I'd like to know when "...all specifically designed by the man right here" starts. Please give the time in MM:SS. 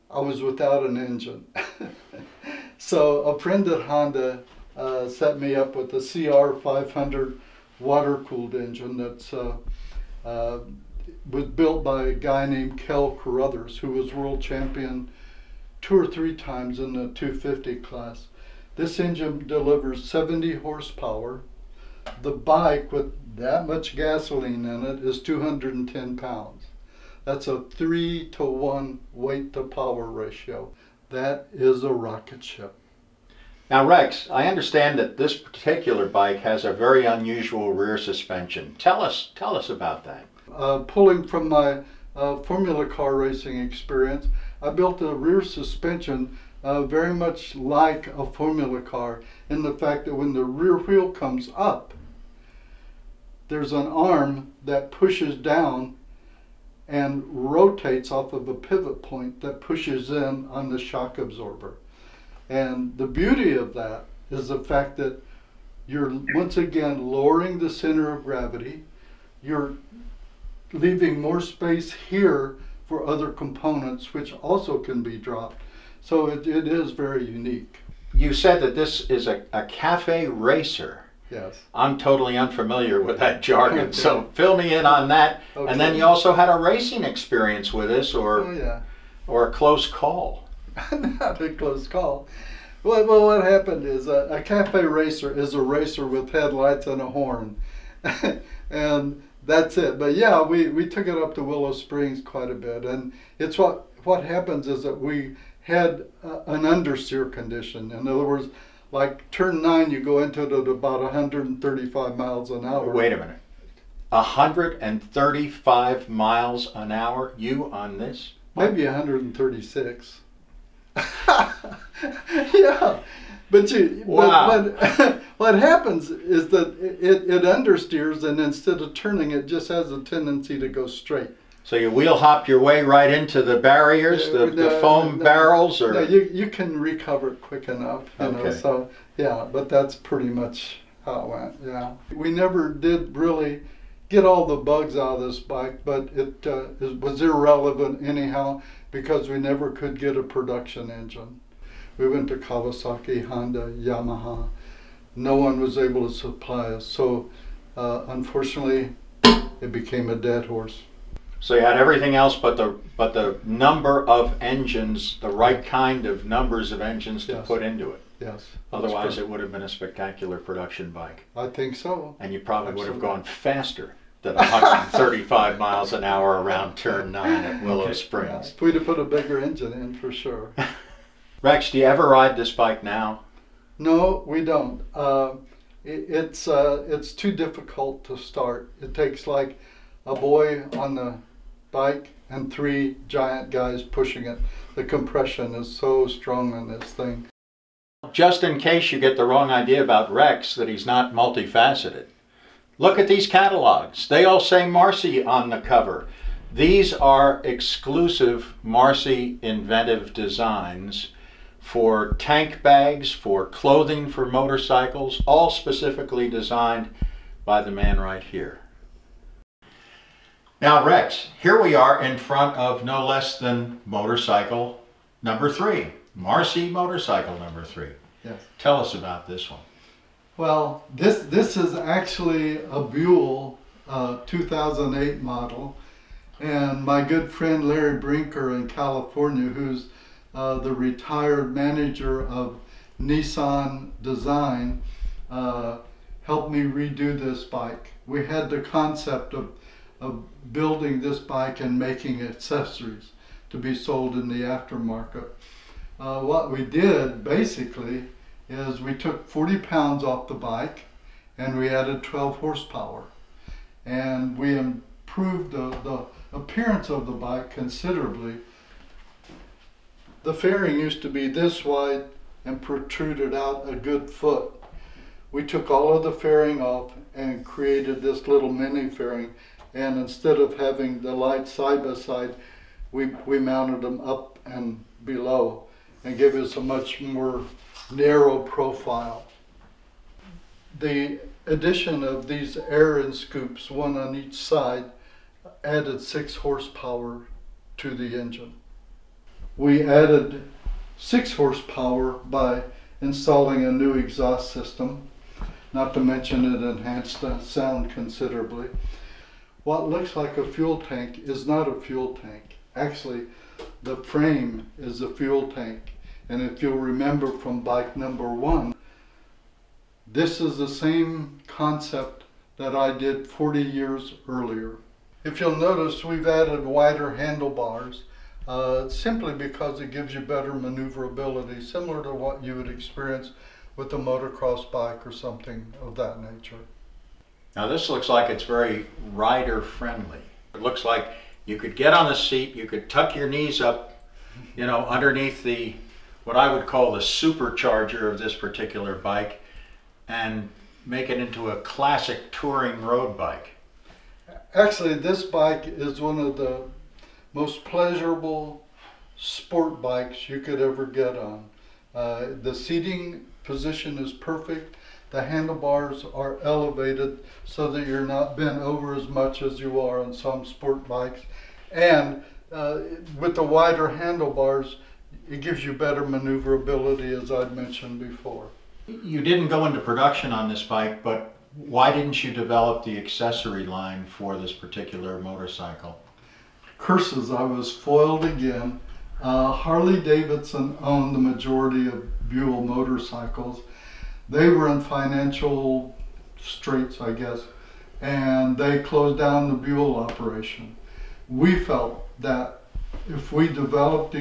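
03:35.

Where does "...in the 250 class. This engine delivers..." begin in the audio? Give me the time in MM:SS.
00:16.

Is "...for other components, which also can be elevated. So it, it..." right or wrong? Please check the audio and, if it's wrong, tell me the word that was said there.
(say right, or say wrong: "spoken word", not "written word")
wrong: "dropped", not "elevated".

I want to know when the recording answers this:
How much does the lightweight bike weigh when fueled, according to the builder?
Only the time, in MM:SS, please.
00:25.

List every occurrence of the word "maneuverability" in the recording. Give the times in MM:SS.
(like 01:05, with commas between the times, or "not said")
05:30, 06:16.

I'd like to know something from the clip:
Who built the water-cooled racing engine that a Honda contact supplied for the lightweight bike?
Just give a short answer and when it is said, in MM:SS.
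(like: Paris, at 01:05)
Kel Carruthers, at 00:12.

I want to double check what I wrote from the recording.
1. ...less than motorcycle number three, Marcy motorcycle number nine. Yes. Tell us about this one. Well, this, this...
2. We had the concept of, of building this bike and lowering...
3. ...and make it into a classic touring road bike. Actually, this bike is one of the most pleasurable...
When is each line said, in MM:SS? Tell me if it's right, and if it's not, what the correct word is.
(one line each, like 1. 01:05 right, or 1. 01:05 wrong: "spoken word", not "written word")
1. 03:43 wrong: "three", not "nine"
2. 04:08 wrong: "making", not "lowering"
3. 05:50 right.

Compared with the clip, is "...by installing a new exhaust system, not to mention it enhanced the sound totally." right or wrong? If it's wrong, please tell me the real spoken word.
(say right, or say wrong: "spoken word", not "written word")
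wrong: "considerably", not "totally".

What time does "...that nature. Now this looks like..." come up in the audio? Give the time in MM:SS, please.
05:35.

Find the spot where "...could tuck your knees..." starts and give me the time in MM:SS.
05:42.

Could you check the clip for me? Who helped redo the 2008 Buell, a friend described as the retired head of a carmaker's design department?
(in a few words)
Larry Brinker.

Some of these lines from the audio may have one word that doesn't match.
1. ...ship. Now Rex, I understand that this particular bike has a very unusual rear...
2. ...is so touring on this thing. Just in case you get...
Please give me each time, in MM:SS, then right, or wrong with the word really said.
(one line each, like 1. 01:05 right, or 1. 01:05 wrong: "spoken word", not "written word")
1. 00:32 right
2. 03:15 wrong: "strong", not "touring".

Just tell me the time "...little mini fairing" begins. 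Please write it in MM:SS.
04:38.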